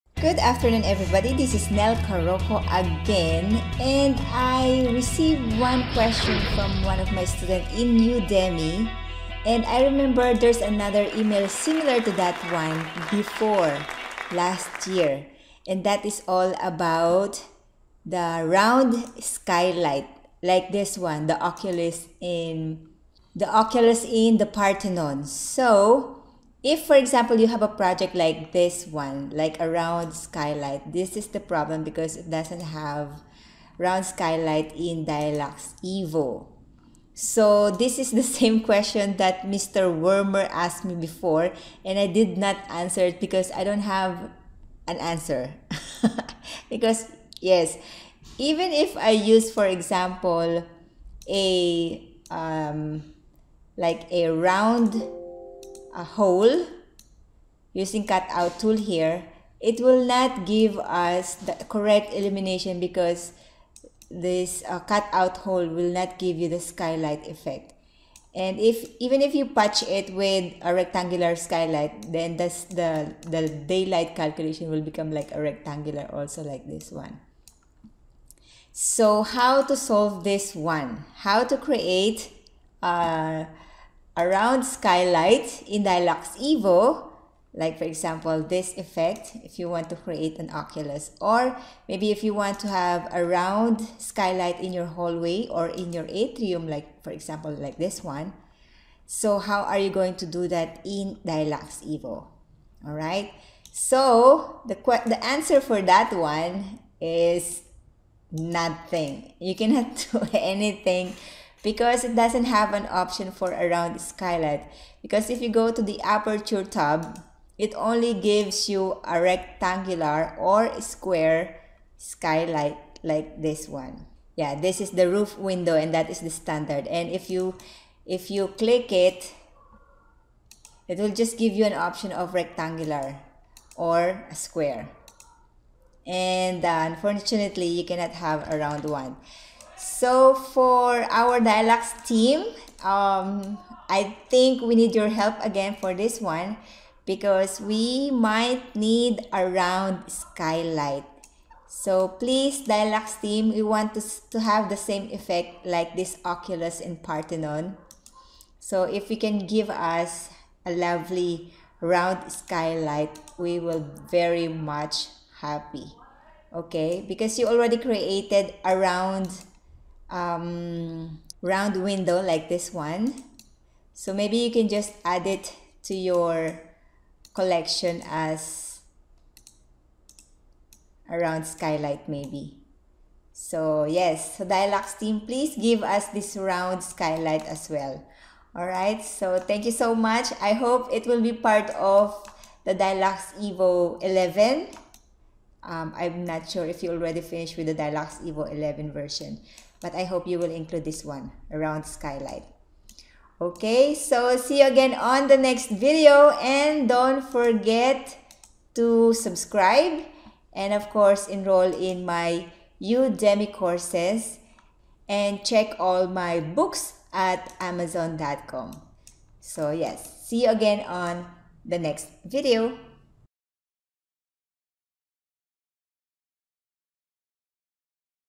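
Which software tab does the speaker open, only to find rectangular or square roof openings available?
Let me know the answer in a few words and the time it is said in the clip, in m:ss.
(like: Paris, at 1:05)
aperture tab, at 1:56.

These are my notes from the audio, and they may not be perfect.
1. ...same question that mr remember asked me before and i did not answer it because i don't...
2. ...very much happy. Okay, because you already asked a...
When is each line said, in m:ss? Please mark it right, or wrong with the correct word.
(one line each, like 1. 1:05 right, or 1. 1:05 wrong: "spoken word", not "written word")
1. 0:38 wrong: "wormer", not "remember"
2. 2:44 wrong: "created", not "asked".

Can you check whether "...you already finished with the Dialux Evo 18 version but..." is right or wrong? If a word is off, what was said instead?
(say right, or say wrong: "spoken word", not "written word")
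wrong: "11", not "18".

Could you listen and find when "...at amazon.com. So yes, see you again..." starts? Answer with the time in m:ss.
3:37.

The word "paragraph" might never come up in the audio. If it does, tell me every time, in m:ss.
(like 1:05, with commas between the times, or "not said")
not said.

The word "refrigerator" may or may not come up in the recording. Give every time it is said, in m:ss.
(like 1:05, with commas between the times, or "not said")
not said.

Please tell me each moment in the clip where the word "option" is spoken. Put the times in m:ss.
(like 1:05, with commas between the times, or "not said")
1:52, 2:11.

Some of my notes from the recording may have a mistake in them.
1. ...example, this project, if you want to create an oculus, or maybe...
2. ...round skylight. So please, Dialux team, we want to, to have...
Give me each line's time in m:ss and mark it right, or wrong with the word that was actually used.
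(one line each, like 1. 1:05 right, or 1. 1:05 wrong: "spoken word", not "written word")
1. 1:27 wrong: "effect", not "project"
2. 2:29 right.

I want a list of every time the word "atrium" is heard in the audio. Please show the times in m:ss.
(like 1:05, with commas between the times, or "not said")
1:36.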